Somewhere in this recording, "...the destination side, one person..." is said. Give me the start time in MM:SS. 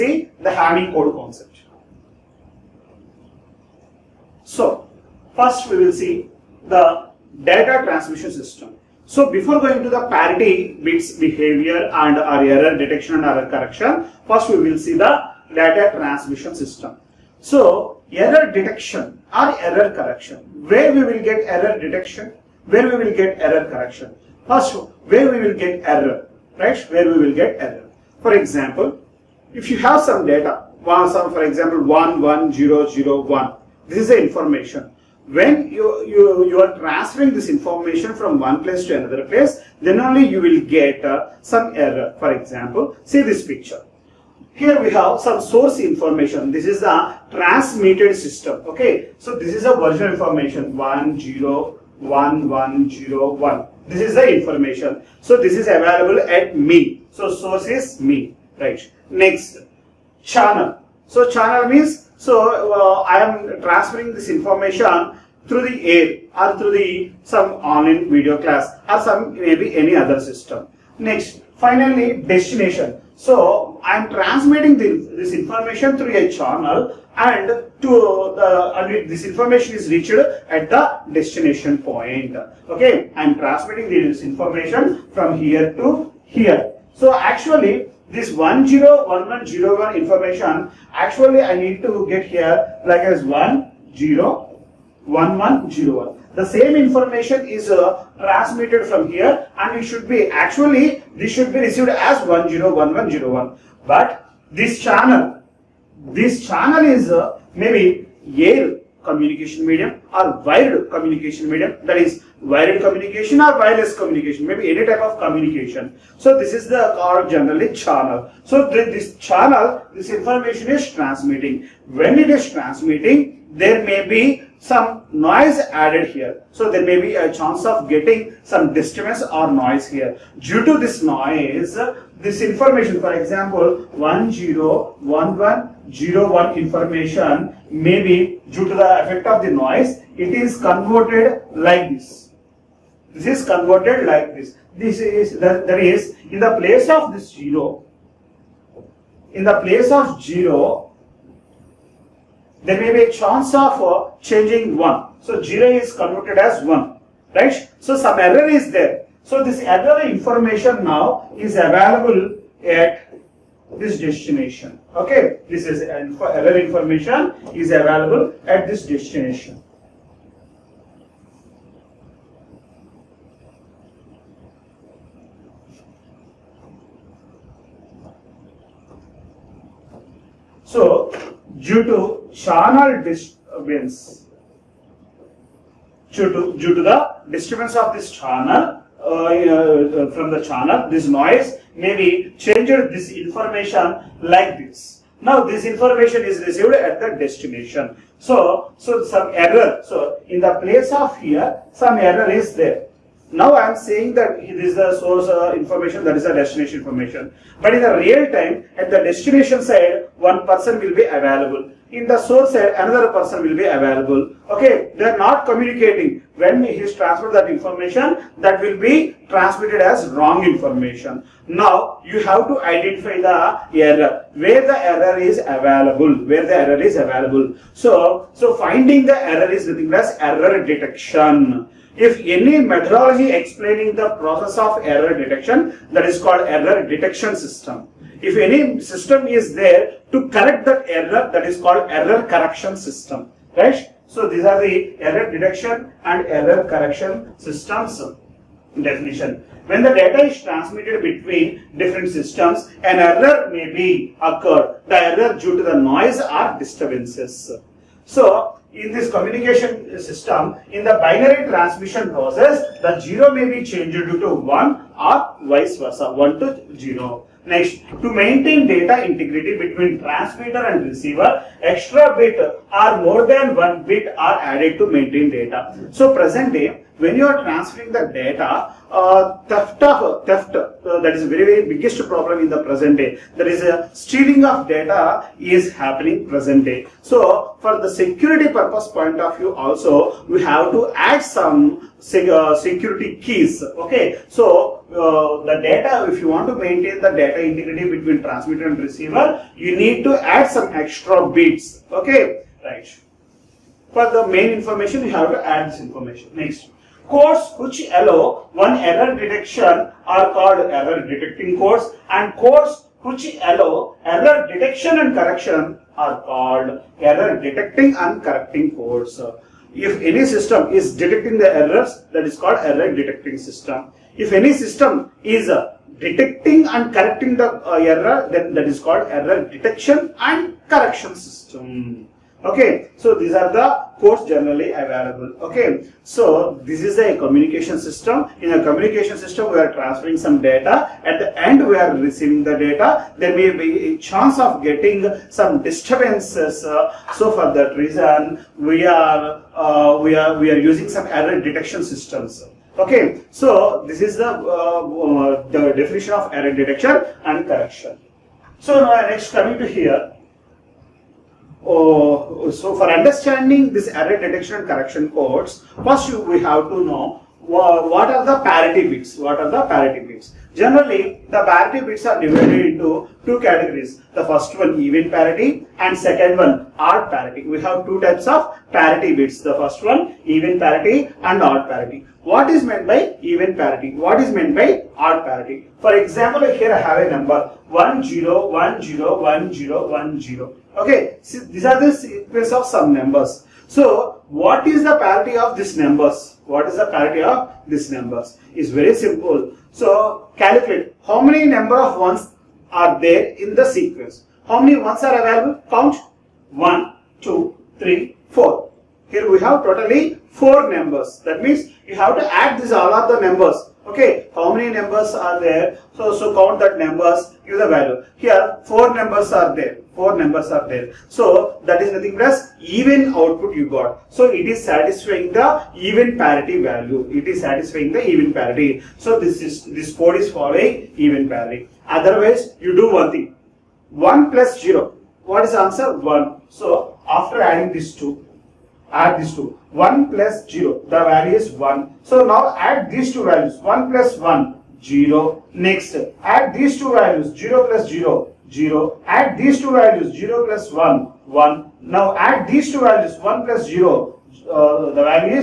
03:28.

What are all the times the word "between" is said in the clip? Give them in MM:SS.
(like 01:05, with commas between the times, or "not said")
04:11, 04:29, 04:57.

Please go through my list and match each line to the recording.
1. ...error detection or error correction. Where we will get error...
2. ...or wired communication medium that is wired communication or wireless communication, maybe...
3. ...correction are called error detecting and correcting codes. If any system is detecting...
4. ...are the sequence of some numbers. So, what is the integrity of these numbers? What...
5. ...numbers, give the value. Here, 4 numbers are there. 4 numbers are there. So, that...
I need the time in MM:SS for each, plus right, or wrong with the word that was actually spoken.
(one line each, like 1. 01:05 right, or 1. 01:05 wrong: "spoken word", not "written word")
1. 00:18 right
2. 01:50 right
3. 05:15 right
4. 06:31 wrong: "parity", not "integrity"
5. 06:56 right.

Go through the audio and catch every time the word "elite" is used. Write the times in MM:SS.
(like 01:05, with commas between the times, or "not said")
not said.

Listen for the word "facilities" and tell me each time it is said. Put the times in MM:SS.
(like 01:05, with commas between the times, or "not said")
not said.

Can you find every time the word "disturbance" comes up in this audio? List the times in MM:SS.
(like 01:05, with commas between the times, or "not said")
02:08, 03:03, 03:07, 04:16, 05:45.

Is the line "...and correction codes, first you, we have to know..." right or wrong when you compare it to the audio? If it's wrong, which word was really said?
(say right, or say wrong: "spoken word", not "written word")
right.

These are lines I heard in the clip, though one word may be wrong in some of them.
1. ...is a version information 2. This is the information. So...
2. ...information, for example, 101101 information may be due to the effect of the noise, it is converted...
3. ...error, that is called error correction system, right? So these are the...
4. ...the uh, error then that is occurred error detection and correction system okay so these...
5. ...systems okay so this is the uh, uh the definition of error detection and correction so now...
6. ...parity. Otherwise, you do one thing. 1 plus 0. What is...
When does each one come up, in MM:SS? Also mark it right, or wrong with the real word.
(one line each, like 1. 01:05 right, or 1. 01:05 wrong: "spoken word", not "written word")
1. 00:49 wrong: "1", not "2"
2. 02:12 right
3. 04:00 right
4. 05:27 wrong: "called", not "occurred"
5. 05:51 right
6. 07:11 right.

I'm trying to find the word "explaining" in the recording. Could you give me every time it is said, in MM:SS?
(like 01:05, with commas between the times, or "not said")
03:53.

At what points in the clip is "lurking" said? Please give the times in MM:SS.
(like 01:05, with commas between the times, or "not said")
not said.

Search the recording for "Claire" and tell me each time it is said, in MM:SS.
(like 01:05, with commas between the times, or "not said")
not said.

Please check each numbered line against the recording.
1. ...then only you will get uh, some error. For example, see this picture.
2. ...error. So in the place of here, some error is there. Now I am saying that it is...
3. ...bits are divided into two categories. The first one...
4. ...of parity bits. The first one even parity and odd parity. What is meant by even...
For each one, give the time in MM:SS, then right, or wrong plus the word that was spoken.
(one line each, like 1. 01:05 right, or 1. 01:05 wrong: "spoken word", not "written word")
1. 00:39 right
2. 03:19 right
3. 06:11 right
4. 06:18 right.